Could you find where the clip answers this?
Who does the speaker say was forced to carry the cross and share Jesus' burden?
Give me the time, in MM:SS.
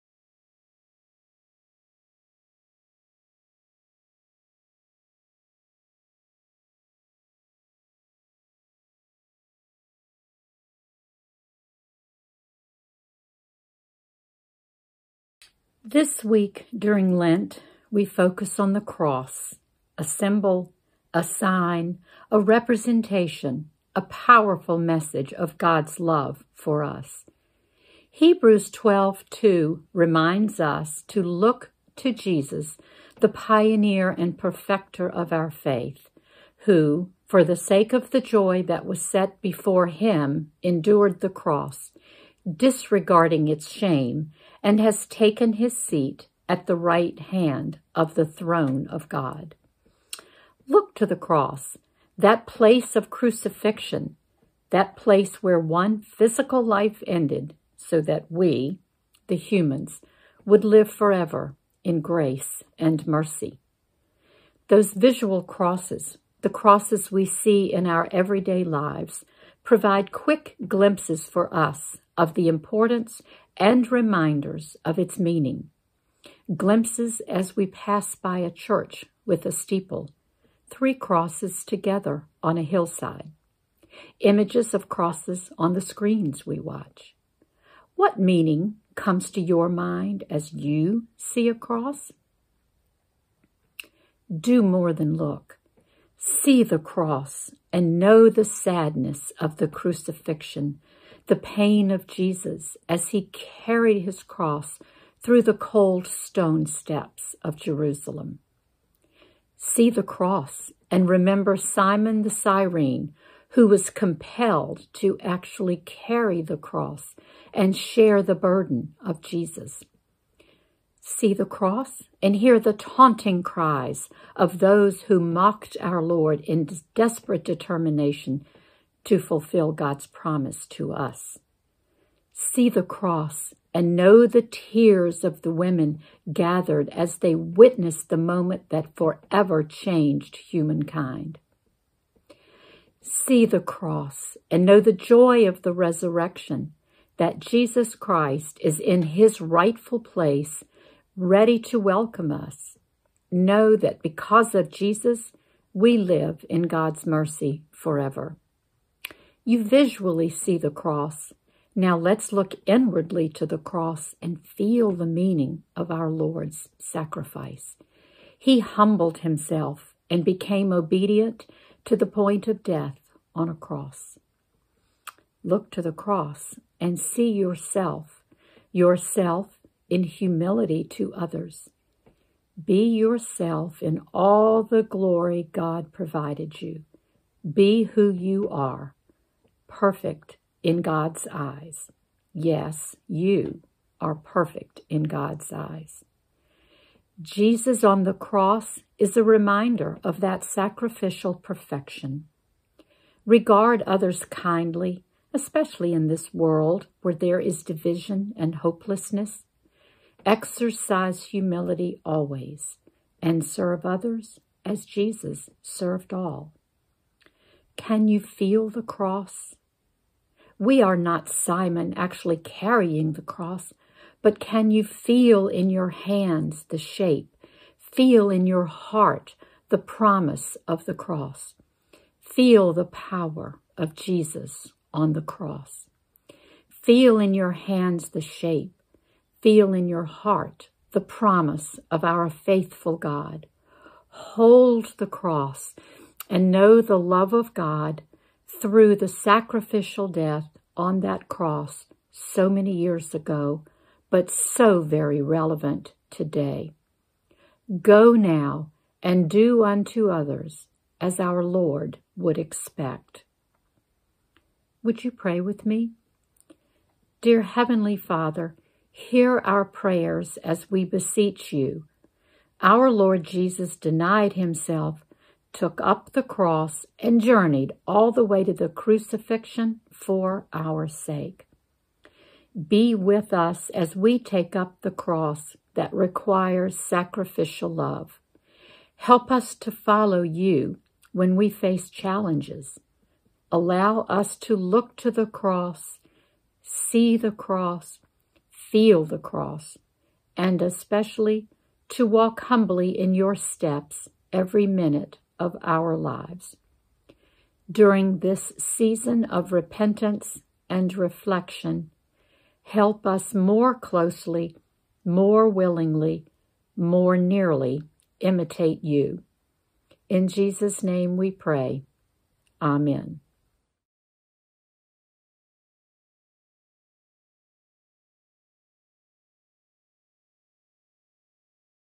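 01:51.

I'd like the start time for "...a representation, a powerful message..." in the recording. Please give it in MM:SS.
00:22.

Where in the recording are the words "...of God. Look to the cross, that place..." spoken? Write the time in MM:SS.
00:48.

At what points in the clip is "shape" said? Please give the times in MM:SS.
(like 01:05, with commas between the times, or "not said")
03:46, 03:58.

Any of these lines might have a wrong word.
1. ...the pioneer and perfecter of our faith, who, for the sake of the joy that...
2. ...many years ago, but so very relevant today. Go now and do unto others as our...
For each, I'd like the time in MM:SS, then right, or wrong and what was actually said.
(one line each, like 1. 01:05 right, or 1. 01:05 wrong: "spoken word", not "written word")
1. 00:33 right
2. 04:12 right.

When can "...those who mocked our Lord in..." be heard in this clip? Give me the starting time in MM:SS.
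02:04.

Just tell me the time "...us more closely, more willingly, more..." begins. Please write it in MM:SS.
05:13.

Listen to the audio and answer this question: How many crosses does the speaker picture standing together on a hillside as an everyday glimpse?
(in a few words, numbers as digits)
3.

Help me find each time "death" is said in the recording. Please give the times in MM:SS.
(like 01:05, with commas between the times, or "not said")
02:52, 04:10.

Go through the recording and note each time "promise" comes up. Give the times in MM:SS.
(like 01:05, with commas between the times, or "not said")
02:10, 03:49, 04:01.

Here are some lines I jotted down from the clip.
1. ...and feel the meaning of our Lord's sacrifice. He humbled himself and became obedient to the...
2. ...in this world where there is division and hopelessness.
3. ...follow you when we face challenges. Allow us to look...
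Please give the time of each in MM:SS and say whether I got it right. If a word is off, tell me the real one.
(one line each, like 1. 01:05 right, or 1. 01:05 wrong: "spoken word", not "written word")
1. 02:44 right
2. 03:25 right
3. 04:49 right.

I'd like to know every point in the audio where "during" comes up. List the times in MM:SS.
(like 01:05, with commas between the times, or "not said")
00:16, 05:07.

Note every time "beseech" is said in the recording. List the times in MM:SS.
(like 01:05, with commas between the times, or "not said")
04:30.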